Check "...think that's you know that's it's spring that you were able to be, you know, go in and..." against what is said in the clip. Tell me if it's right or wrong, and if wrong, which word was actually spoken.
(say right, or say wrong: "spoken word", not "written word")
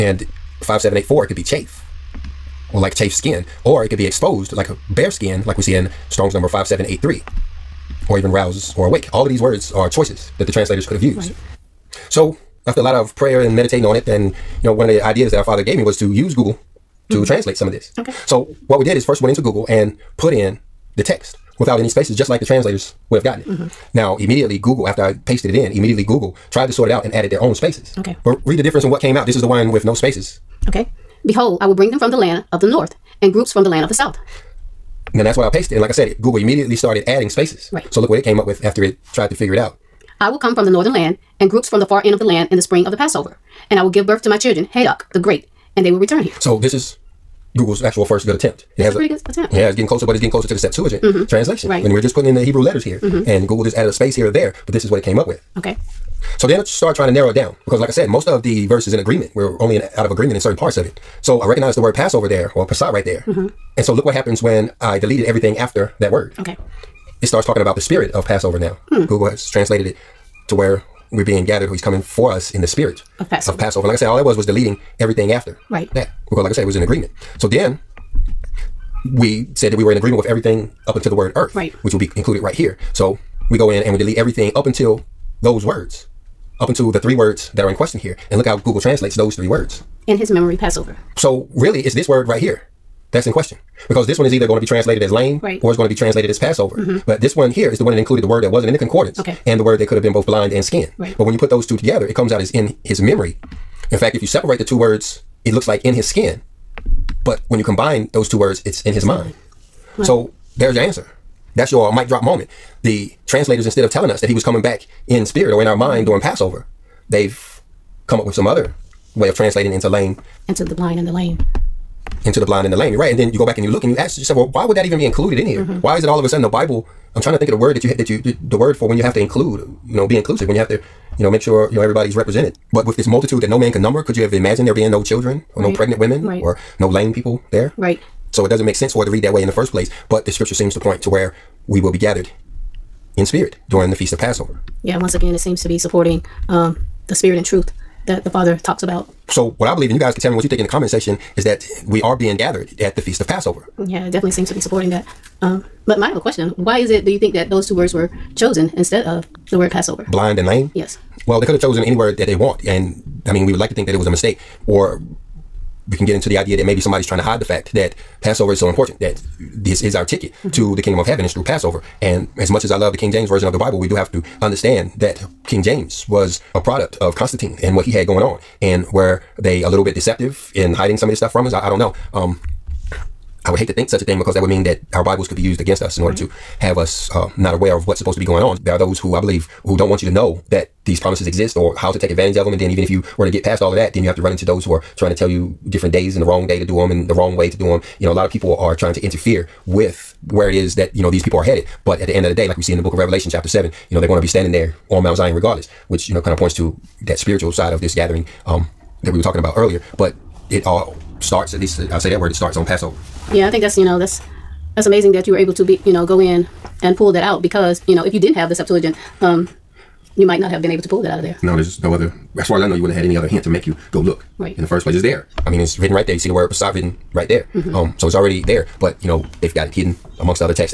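wrong: "amazing", not "spring".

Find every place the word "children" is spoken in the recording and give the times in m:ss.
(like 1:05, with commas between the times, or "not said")
0:44, 2:15.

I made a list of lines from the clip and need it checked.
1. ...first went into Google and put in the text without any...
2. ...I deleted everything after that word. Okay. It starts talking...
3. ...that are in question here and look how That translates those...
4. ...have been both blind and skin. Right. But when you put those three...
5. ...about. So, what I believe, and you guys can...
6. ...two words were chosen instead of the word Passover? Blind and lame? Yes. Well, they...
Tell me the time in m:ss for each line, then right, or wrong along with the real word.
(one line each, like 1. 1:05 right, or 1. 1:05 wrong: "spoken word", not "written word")
1. 0:19 right
2. 1:04 right
3. 1:27 wrong: "Google", not "That"
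4. 1:39 wrong: "two", not "three"
5. 2:28 right
6. 2:37 right.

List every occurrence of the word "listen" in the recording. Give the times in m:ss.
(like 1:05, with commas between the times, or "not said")
not said.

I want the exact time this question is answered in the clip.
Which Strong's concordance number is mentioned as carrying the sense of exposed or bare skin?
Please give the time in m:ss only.
0:06.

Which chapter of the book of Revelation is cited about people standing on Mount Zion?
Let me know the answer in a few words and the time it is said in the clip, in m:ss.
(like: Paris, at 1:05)
Chapter 7, at 3:23.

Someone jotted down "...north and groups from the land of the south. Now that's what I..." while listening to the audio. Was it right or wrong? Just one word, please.
right.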